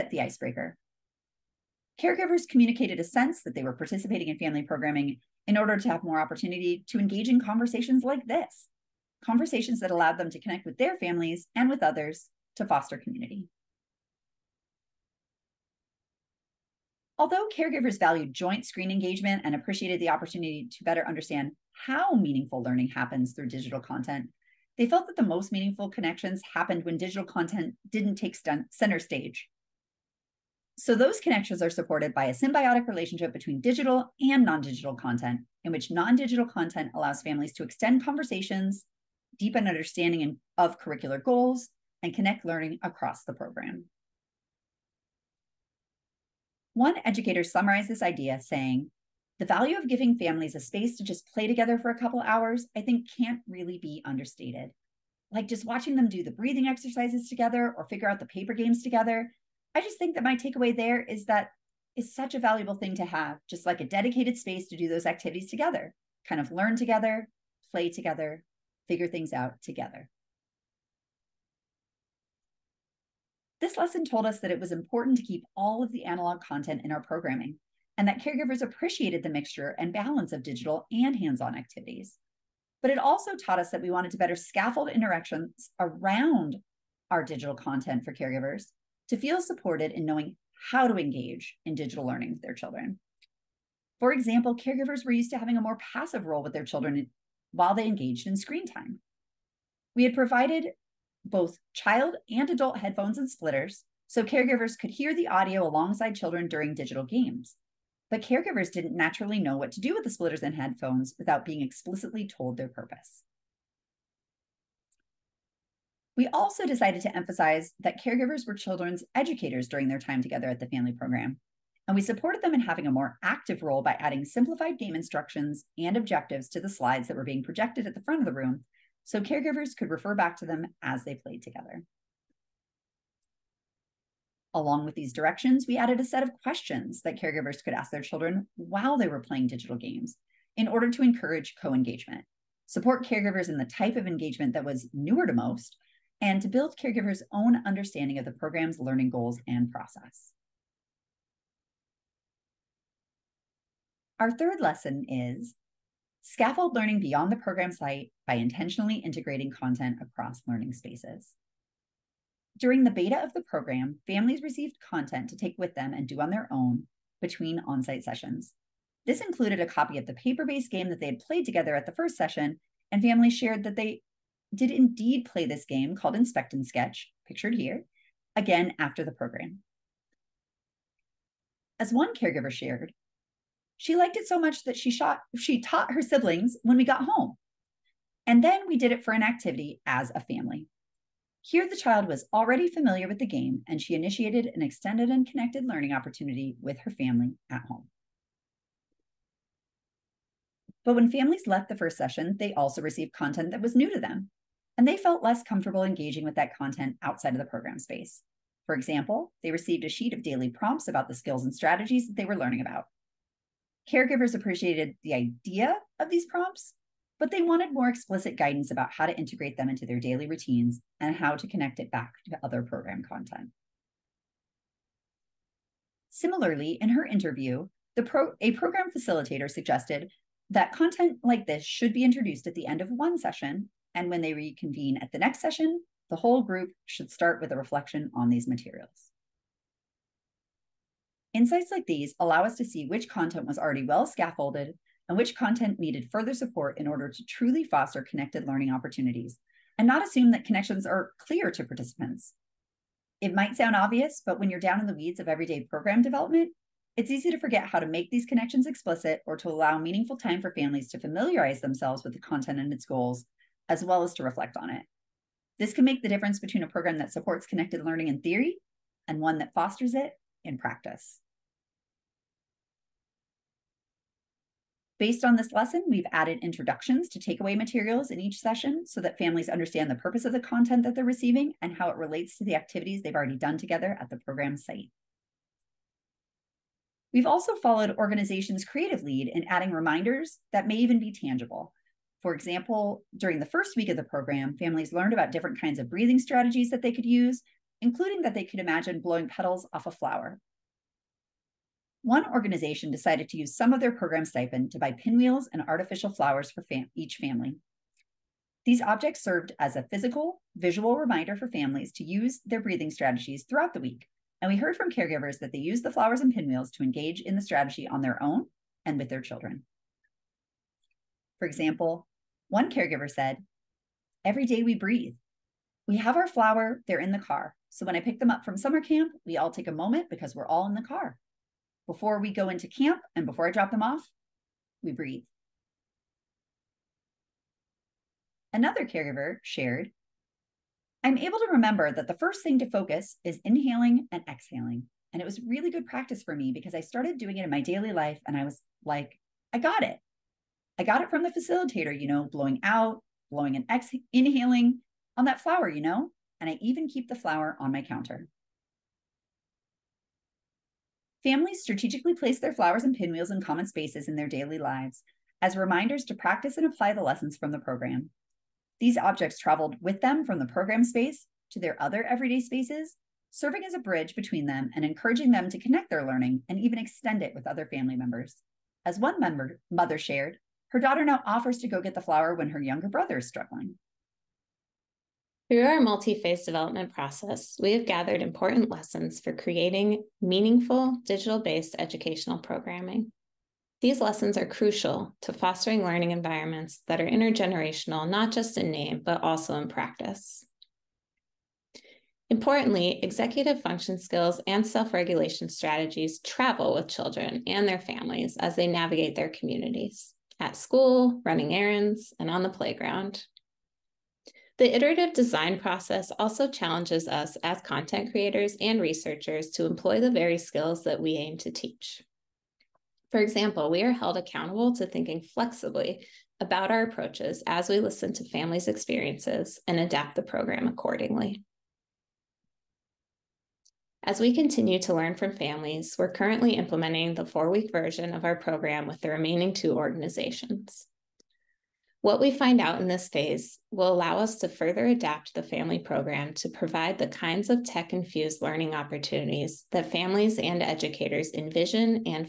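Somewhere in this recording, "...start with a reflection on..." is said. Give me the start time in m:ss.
3:57.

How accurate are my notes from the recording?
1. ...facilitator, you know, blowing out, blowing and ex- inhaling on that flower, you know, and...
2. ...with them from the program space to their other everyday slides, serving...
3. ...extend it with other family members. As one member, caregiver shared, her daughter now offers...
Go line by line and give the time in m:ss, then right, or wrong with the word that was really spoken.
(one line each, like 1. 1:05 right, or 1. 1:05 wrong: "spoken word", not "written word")
1. 5:51 right
2. 6:09 wrong: "spaces", not "slides"
3. 6:16 wrong: "mother", not "caregiver".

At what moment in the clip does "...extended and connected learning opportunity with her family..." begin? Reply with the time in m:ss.
3:14.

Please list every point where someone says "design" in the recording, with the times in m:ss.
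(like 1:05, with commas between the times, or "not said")
6:55.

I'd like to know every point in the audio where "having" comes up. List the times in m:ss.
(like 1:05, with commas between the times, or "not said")
1:35, 2:02.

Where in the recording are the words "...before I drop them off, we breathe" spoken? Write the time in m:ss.
5:33.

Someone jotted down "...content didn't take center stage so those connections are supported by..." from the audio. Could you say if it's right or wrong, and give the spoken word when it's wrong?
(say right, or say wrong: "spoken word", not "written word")
right.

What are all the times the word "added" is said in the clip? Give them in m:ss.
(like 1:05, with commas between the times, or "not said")
2:15, 4:36.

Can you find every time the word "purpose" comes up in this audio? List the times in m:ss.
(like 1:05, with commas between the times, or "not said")
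1:52, 4:39.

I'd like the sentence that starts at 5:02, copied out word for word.
One organization decided to use some of their program stipend to buy pinwheels and artificial flowers for fam each family.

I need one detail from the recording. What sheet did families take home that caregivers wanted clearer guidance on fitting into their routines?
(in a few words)
daily prompts.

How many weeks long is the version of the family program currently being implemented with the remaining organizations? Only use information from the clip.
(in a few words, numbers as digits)
4.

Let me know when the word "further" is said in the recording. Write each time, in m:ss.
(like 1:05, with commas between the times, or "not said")
4:06, 7:24.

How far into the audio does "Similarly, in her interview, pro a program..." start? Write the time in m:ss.
3:46.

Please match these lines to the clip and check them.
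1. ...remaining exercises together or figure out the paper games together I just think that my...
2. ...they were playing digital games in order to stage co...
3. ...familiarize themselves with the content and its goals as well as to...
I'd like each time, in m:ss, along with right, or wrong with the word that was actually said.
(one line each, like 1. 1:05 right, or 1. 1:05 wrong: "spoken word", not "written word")
1. 0:56 wrong: "breathing", not "remaining"
2. 2:18 wrong: "encourage", not "stage"
3. 4:20 right.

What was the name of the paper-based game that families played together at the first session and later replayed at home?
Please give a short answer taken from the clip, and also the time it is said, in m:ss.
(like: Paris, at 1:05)
Inspect and Sketch, at 2:56.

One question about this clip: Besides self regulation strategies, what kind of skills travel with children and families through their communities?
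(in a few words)
executive function skills.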